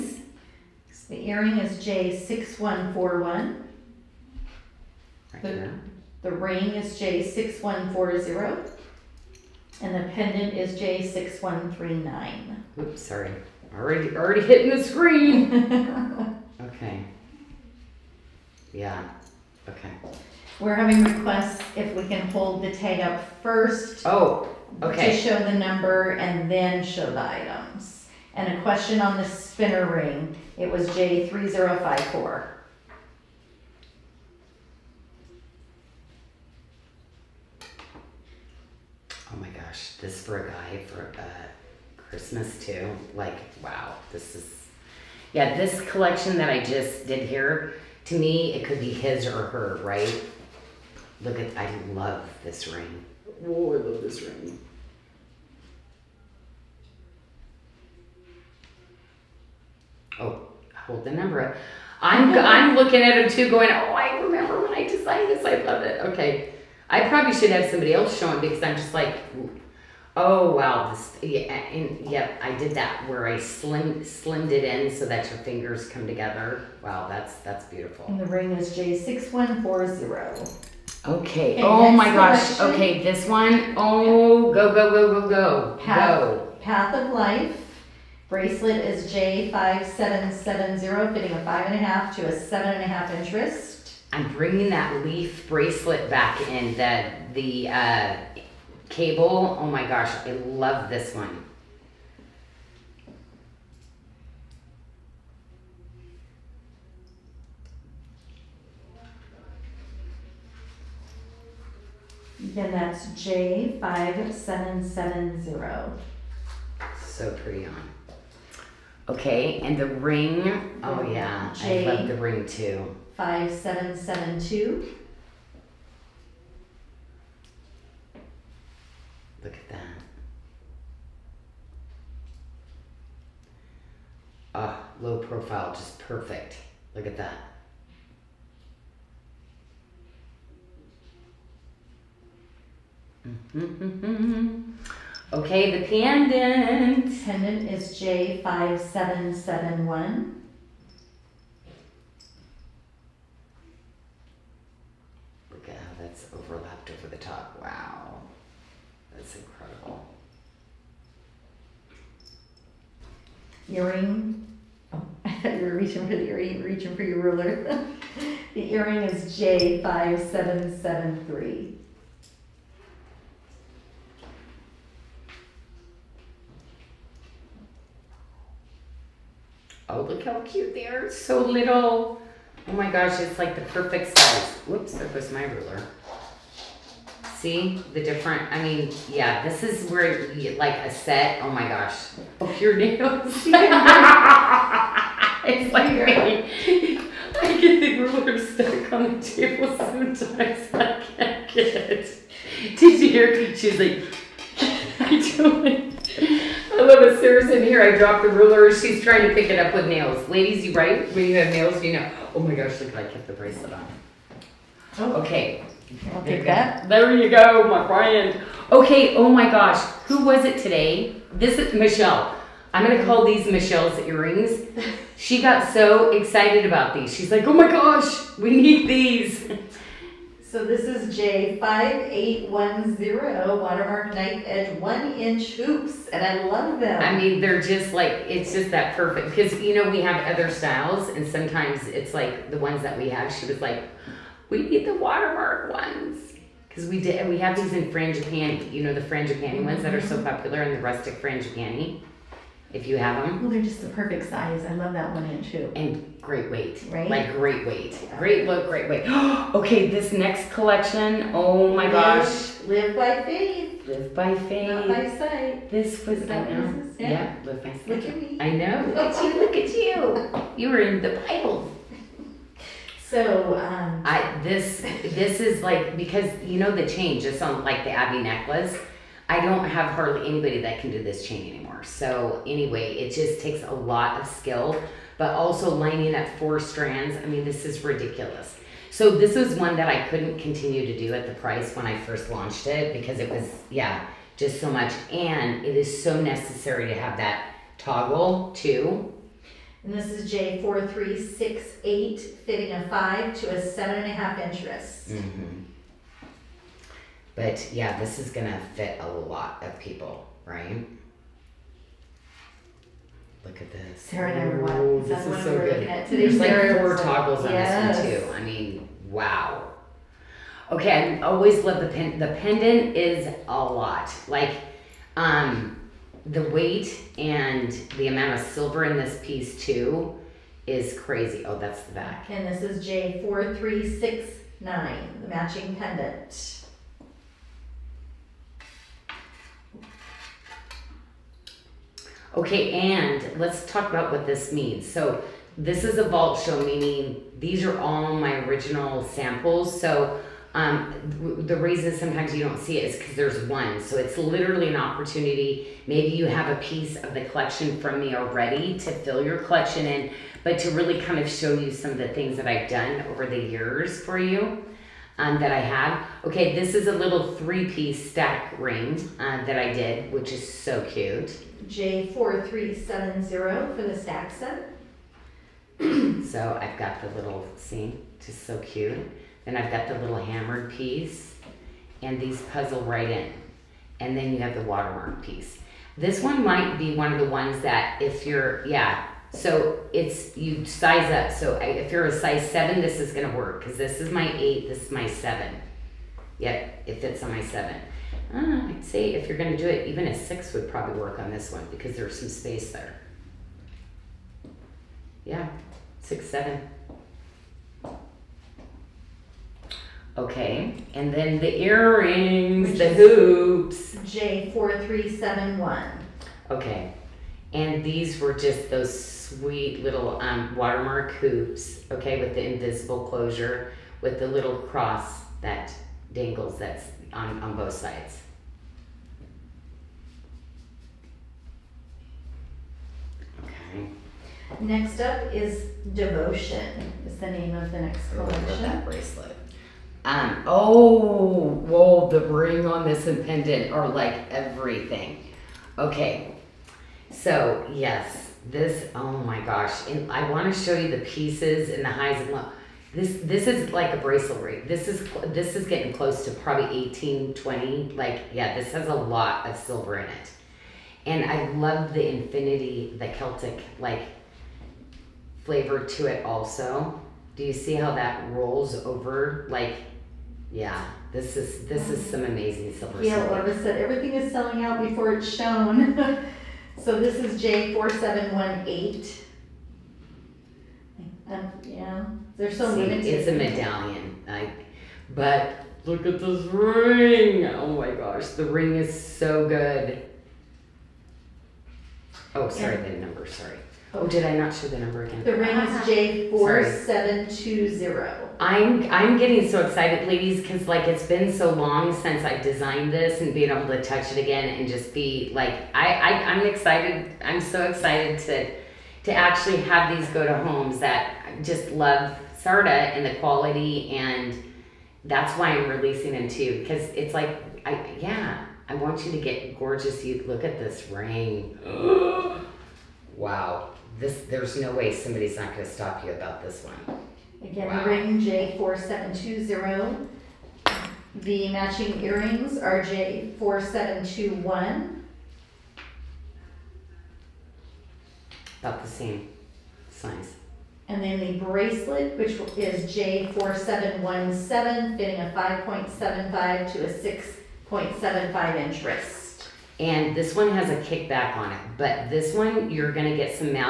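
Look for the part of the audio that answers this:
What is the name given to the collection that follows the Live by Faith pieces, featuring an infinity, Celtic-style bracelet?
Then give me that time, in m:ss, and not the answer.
7:15.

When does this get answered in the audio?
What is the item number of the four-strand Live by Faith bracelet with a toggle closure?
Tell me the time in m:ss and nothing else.
5:00.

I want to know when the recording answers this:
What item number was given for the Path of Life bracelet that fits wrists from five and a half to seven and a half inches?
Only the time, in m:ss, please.
1:29.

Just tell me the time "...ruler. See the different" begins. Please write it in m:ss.
3:05.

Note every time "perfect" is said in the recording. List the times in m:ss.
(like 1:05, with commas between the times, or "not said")
2:15, 3:03, 3:58, 4:13.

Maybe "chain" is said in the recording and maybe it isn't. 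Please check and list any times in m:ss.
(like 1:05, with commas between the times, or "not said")
4:36, 4:41.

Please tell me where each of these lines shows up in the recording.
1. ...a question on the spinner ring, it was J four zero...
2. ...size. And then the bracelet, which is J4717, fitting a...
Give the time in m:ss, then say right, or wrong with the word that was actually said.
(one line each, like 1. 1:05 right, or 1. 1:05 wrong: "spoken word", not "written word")
1. 0:28 wrong: "three", not "four"
2. 8:59 right.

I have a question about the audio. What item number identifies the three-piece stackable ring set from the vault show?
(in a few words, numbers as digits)
J4370.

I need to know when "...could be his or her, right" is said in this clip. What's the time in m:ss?
0:48.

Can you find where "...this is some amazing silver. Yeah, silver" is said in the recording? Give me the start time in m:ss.
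7:51.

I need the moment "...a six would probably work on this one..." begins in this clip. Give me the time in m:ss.
6:40.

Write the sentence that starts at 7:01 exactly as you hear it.
Okay, with the invisible closure, with the little cross that dangles that's on, on both sides.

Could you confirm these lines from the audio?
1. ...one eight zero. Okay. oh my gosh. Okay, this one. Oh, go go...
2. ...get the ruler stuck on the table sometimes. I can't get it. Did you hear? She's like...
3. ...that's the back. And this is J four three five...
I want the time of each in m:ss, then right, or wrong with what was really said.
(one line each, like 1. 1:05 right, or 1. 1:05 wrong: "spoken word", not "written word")
1. 1:19 wrong: "four", not "eight"
2. 3:17 right
3. 5:31 wrong: "six", not "five".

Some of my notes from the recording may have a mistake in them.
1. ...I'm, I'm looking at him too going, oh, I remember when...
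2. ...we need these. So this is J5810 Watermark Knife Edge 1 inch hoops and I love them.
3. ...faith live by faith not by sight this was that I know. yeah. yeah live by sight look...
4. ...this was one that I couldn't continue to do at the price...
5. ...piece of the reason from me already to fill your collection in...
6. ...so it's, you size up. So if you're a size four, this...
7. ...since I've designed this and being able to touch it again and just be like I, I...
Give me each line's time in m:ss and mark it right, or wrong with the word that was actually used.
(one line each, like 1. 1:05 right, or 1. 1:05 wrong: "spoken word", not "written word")
1. 1:02 right
2. 3:48 right
3. 4:23 right
4. 4:49 right
5. 5:56 wrong: "collection", not "reason"
6. 6:29 wrong: "seven", not "four"
7. 8:21 right.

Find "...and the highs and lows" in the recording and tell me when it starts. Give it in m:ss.
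7:31.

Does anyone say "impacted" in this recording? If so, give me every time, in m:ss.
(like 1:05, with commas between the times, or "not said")
not said.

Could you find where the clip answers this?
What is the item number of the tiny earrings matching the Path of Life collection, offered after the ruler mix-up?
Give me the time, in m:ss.
2:49.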